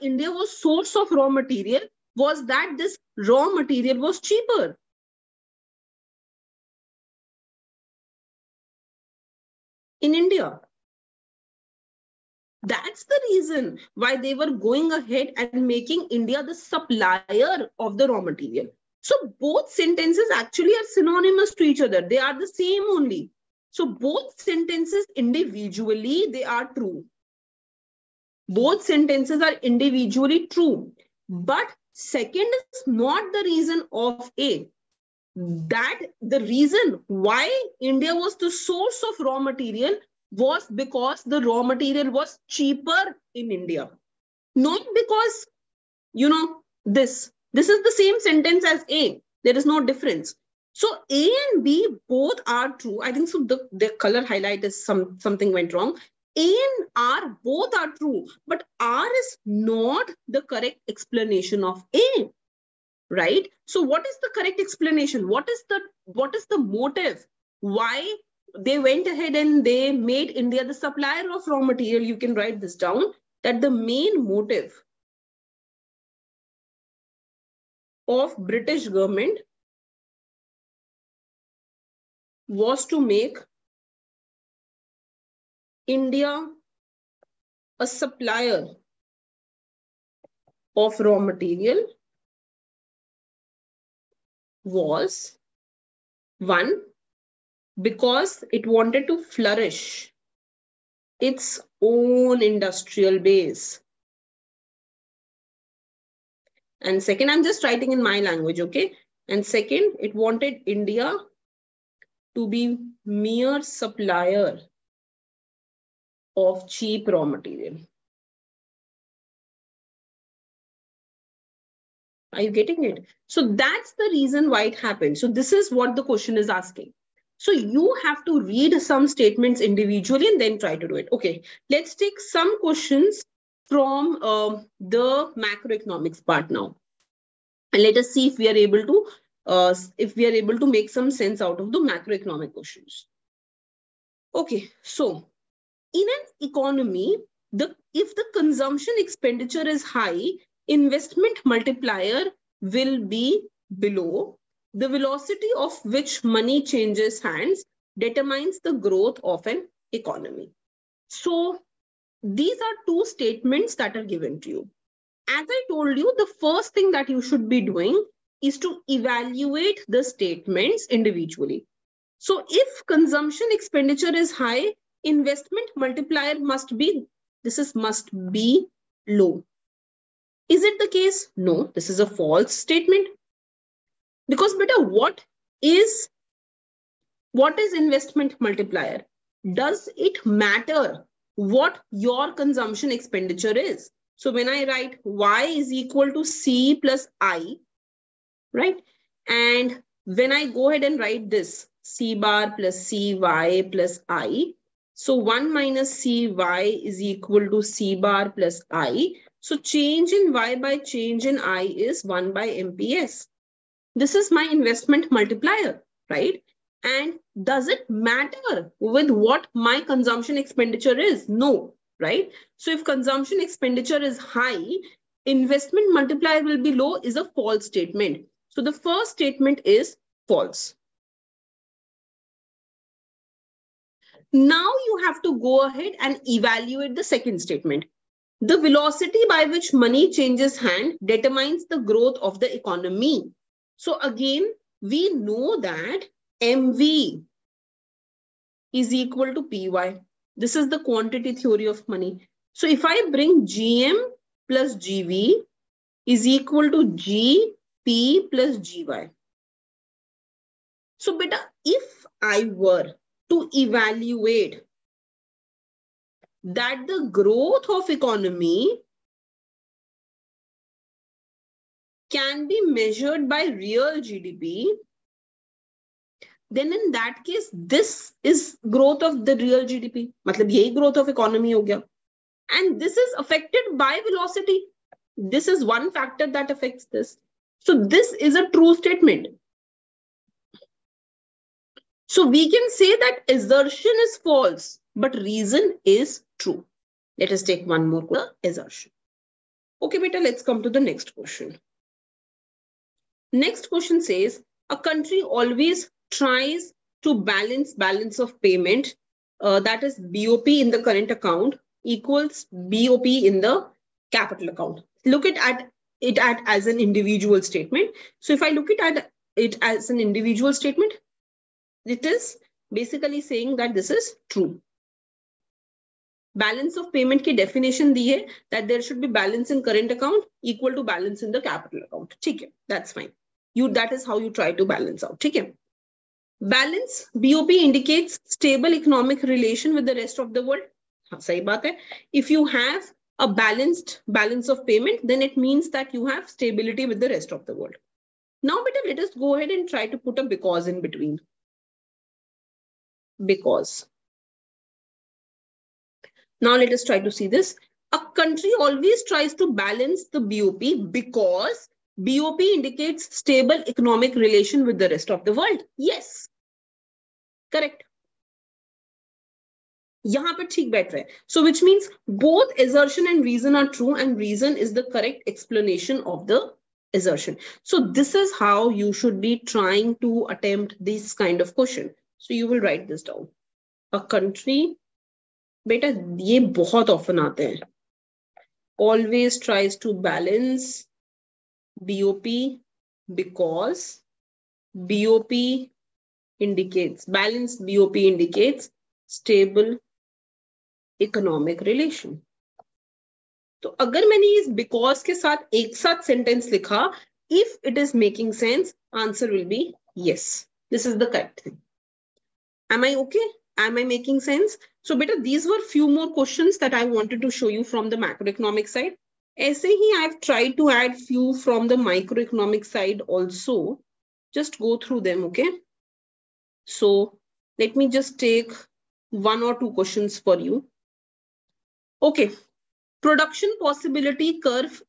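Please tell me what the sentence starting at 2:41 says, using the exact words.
So these are two statements that are given to you.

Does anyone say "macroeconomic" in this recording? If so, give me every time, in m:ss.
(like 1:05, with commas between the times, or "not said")
2:15, 2:21, 6:57.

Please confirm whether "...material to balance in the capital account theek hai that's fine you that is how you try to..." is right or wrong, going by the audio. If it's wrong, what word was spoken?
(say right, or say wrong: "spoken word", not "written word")
wrong: "equal", not "material".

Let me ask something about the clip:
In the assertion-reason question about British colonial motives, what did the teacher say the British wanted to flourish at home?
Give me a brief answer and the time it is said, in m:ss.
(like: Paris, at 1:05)
Its own industrial base, at 1:41.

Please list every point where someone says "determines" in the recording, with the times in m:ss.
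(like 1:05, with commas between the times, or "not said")
2:37, 4:01.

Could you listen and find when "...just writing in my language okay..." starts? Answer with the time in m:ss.
1:47.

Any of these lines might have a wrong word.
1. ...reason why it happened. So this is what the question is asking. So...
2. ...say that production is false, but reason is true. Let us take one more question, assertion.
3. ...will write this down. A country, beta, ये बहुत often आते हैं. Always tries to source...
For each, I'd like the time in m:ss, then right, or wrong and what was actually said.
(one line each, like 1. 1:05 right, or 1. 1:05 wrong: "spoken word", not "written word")
1. 2:04 right
2. 4:52 wrong: "assertion", not "production"
3. 6:22 wrong: "balance", not "source".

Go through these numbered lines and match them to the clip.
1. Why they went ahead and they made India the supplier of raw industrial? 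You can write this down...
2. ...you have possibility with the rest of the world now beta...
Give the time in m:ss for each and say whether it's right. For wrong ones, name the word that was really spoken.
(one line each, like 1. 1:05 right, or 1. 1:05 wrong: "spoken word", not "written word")
1. 1:07 wrong: "material", not "industrial"
2. 5:45 wrong: "stability", not "possibility".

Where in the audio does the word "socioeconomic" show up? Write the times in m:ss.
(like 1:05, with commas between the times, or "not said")
not said.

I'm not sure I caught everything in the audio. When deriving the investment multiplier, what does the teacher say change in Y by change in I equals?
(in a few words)
1 by MPS.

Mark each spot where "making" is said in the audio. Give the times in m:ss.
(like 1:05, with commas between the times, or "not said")
0:15, 6:53.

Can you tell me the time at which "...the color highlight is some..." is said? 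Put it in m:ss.
0:53.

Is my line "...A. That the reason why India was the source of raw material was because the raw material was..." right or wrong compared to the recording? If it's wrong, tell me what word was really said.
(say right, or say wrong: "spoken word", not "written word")
right.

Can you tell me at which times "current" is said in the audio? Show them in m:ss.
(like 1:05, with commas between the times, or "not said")
5:10, 5:29.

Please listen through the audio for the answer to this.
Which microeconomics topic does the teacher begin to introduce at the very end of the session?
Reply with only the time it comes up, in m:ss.
7:13.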